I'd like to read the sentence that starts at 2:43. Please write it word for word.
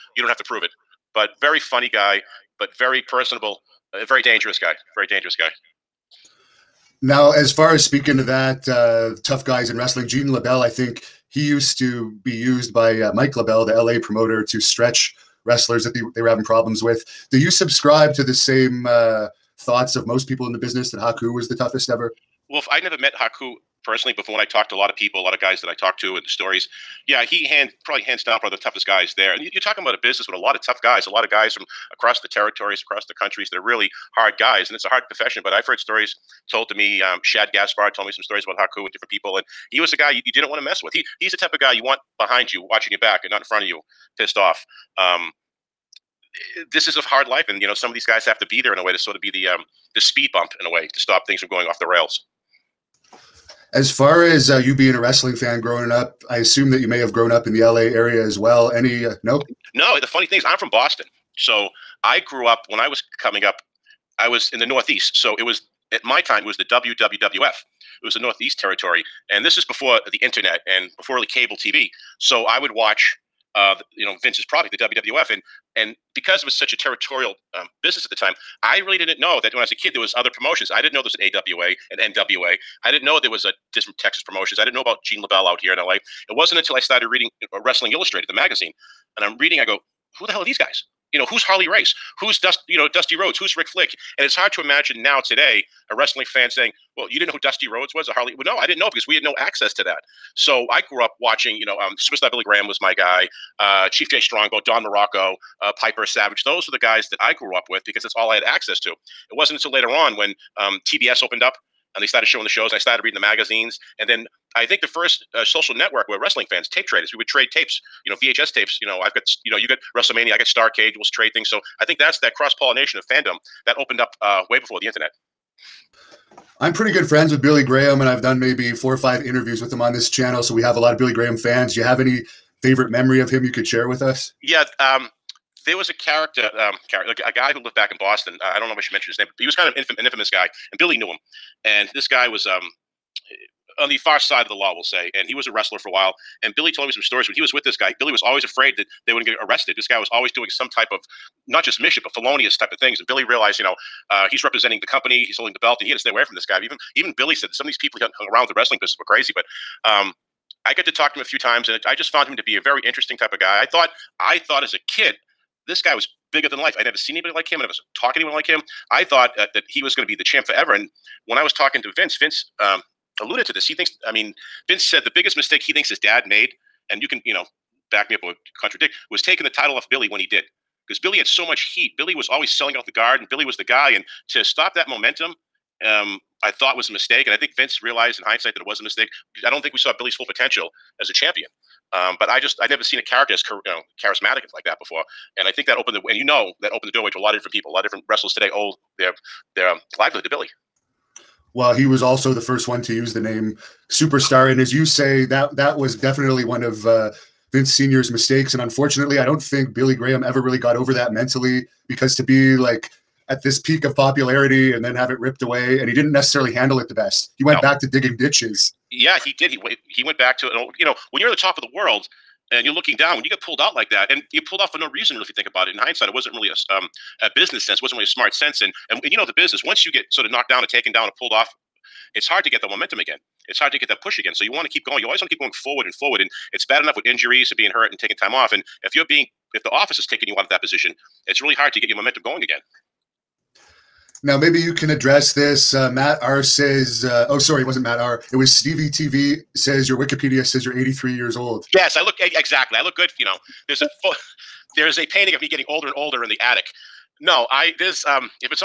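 I thought I thought as a kid, this guy was bigger than life.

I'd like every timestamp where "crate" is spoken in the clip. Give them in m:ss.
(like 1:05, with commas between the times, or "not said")
not said.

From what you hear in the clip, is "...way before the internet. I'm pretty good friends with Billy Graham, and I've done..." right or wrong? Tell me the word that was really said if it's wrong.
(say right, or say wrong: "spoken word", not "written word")
right.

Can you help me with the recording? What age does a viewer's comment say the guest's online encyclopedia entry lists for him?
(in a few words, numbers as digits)
83.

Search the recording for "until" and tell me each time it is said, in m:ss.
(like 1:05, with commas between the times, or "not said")
1:26, 1:49.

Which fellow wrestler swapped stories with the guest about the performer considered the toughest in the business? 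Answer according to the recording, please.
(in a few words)
Shad Gaspard.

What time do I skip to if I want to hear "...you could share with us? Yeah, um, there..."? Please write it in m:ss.
2:13.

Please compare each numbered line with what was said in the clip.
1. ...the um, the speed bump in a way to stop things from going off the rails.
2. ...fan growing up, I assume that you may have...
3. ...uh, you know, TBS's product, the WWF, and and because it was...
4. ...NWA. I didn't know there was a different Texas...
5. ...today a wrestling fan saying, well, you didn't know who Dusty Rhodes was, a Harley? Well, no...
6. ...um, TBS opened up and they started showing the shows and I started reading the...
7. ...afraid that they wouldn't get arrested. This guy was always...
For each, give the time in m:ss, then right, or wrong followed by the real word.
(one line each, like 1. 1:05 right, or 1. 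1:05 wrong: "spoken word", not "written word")
1. 0:49 right
2. 0:55 right
3. 1:13 wrong: "Vince", not "TBS"
4. 1:22 right
5. 1:35 right
6. 1:50 right
7. 2:28 right.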